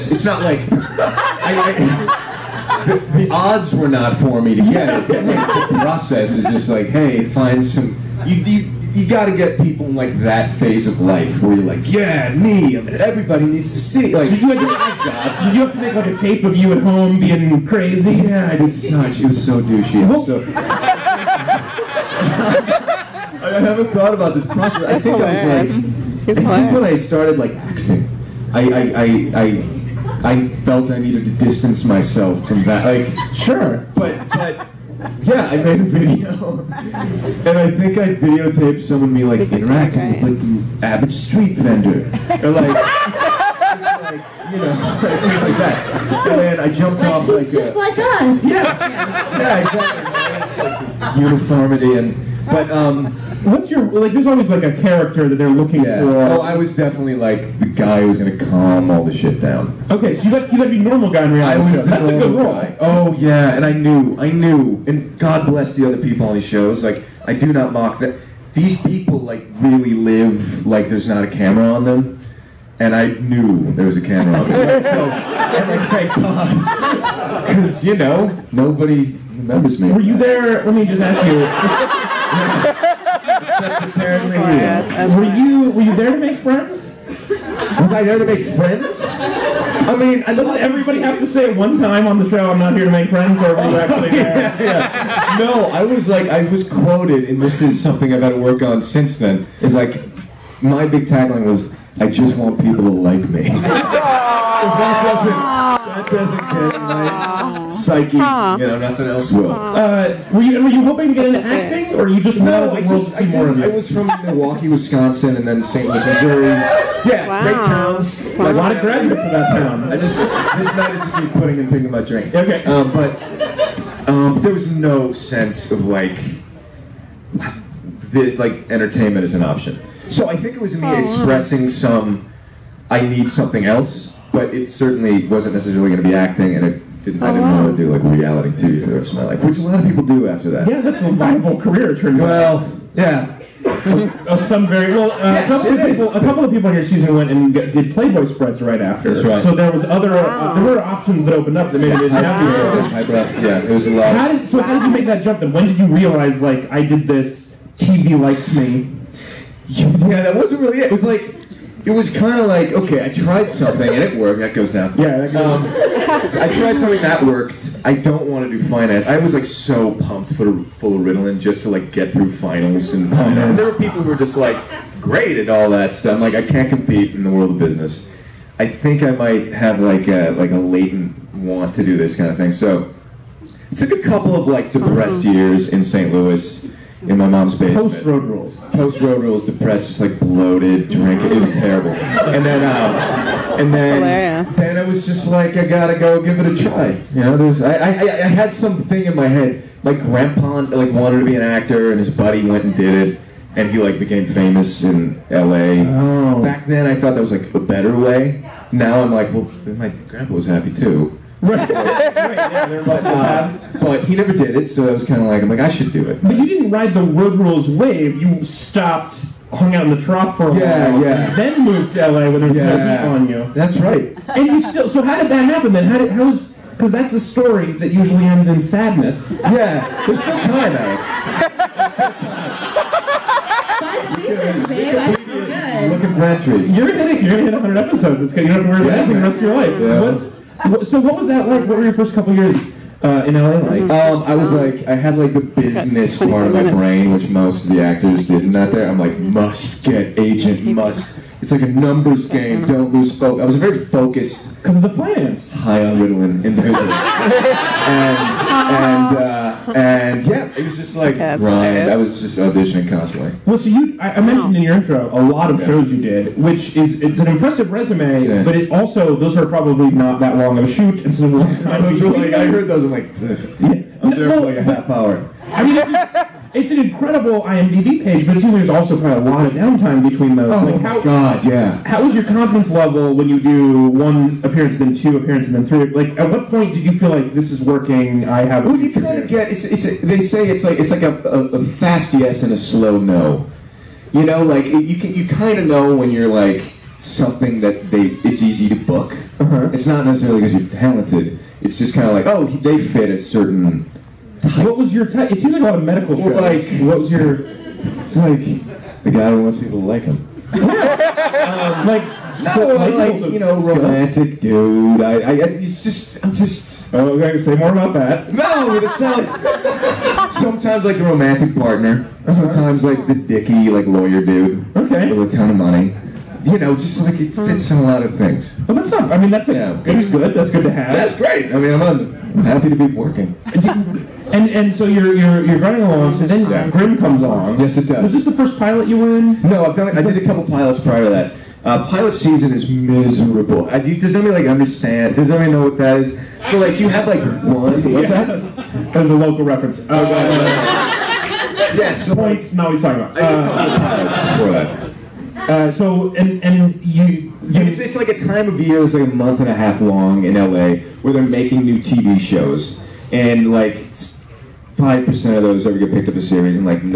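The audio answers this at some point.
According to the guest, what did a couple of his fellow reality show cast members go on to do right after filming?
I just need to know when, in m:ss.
2:27.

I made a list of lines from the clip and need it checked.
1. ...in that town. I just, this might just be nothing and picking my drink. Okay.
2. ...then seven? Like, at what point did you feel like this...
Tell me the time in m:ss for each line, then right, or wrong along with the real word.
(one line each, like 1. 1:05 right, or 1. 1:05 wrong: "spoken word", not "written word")
1. 1:59 wrong: "putting", not "nothing"
2. 4:45 wrong: "three", not "seven".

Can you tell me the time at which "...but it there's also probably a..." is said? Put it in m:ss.
4:38.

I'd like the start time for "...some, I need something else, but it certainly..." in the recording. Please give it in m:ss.
2:11.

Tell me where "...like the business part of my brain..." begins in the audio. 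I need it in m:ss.
4:05.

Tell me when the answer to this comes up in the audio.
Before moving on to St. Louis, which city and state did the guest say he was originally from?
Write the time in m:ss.
1:54.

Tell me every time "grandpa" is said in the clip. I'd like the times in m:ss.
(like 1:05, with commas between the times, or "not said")
3:19, 3:29.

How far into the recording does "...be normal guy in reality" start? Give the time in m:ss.
1:00.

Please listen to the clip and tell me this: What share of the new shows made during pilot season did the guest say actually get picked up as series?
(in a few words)
5 percent.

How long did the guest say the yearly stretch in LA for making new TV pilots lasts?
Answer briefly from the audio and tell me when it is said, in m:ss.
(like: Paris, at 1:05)
A month and a half, at 5:59.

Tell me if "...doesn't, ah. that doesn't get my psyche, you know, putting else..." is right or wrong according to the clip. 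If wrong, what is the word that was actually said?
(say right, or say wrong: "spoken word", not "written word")
wrong: "nothing", not "putting".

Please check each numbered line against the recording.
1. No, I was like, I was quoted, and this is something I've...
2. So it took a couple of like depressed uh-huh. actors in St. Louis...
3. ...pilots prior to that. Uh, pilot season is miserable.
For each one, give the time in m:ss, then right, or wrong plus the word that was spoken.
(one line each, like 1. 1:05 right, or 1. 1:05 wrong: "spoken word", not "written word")
1. 1:35 right
2. 3:02 wrong: "years", not "actors"
3. 5:40 right.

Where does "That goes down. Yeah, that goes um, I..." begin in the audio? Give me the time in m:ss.
2:44.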